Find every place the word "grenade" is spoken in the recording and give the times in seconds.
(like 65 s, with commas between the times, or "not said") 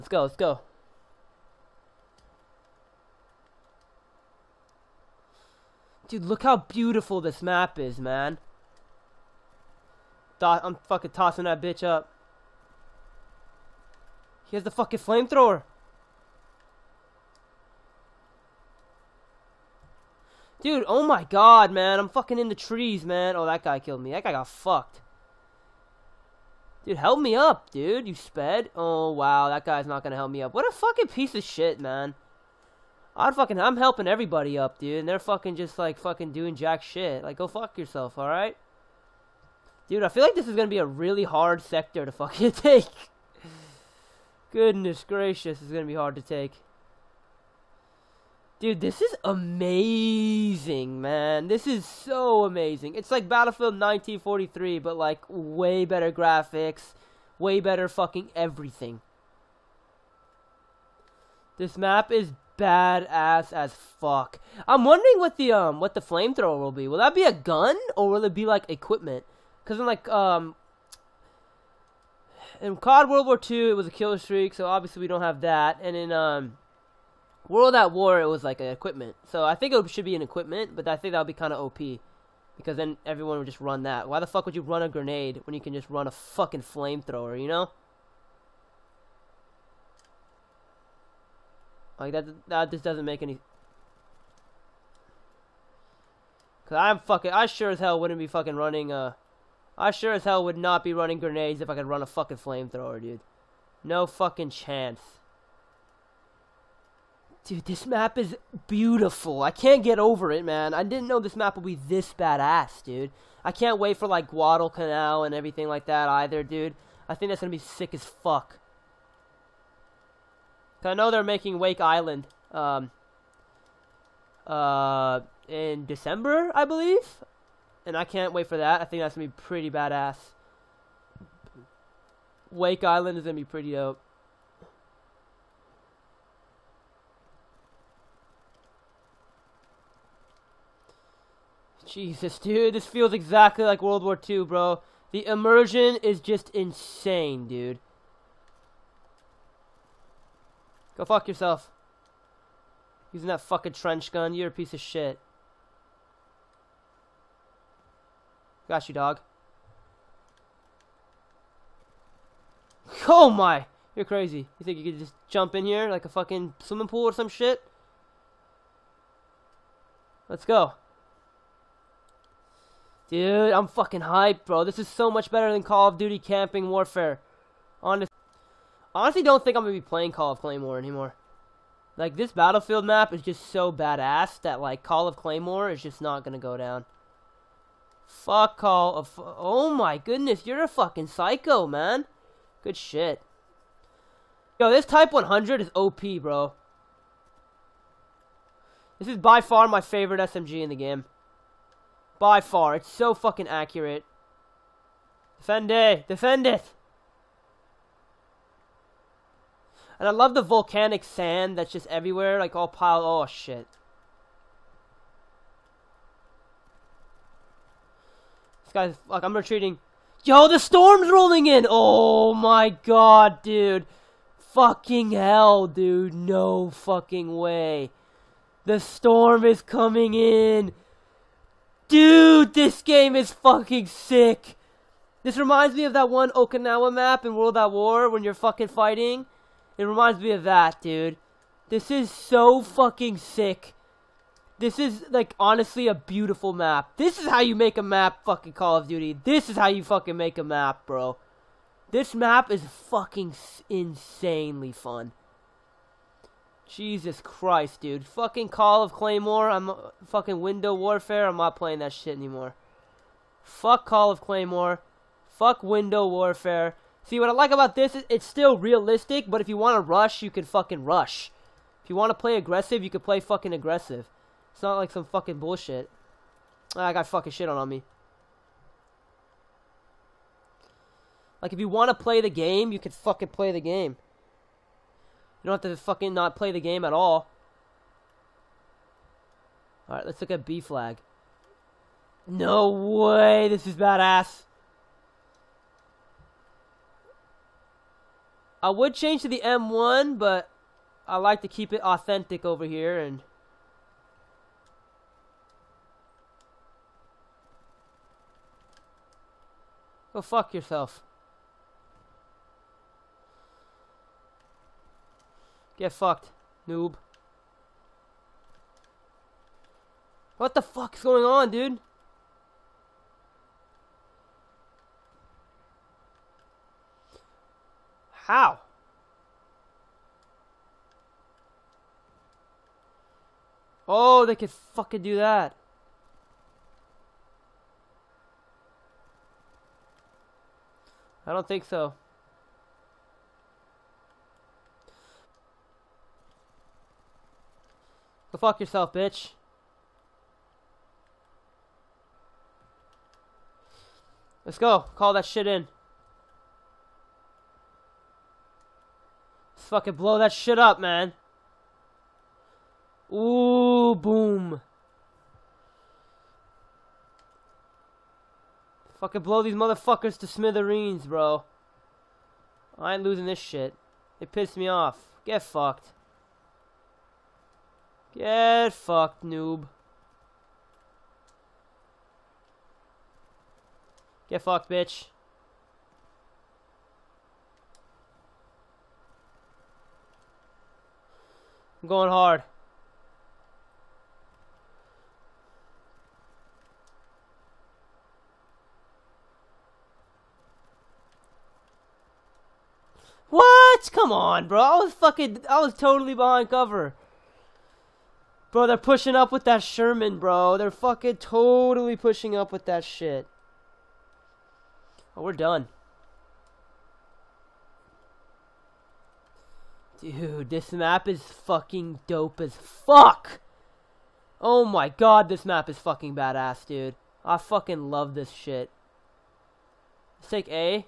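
84 s, 101 s.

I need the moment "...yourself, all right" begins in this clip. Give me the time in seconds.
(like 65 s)
37 s.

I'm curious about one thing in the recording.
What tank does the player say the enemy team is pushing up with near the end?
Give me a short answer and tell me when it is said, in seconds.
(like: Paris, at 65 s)
Sherman, at 409 s.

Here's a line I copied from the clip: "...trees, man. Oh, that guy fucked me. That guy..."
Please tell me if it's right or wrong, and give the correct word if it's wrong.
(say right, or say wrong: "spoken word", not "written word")
wrong: "killed", not "fucked".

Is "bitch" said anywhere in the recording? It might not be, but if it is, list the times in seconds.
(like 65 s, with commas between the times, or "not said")
11 s, 348 s, 384 s.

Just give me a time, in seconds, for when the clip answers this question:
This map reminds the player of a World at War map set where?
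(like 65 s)
236 s.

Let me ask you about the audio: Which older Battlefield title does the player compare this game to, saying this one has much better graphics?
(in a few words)
Battlefield 1943.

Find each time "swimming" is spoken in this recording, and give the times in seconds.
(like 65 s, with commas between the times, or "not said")
166 s.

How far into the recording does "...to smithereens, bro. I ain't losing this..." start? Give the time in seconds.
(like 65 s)
370 s.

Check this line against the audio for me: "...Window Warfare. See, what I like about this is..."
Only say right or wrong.
right.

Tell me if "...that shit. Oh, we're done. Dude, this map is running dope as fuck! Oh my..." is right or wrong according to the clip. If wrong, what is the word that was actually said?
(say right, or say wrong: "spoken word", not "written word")
wrong: "fucking", not "running".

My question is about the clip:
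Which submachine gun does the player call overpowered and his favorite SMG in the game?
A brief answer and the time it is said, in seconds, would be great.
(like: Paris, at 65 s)
Type 100, at 194 s.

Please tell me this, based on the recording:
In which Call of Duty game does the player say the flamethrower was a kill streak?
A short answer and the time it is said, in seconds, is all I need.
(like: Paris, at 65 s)
COD World War II, at 72 s.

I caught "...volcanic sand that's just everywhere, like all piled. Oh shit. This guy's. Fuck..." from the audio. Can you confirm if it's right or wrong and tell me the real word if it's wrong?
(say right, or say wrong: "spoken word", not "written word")
right.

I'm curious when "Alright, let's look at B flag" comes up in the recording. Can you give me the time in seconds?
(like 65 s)
289 s.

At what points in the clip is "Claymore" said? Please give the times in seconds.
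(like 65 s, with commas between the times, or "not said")
180 s, 185 s, 258 s, 264 s.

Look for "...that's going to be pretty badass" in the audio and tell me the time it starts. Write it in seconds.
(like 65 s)
129 s.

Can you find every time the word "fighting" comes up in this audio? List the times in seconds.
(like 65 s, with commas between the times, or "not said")
238 s.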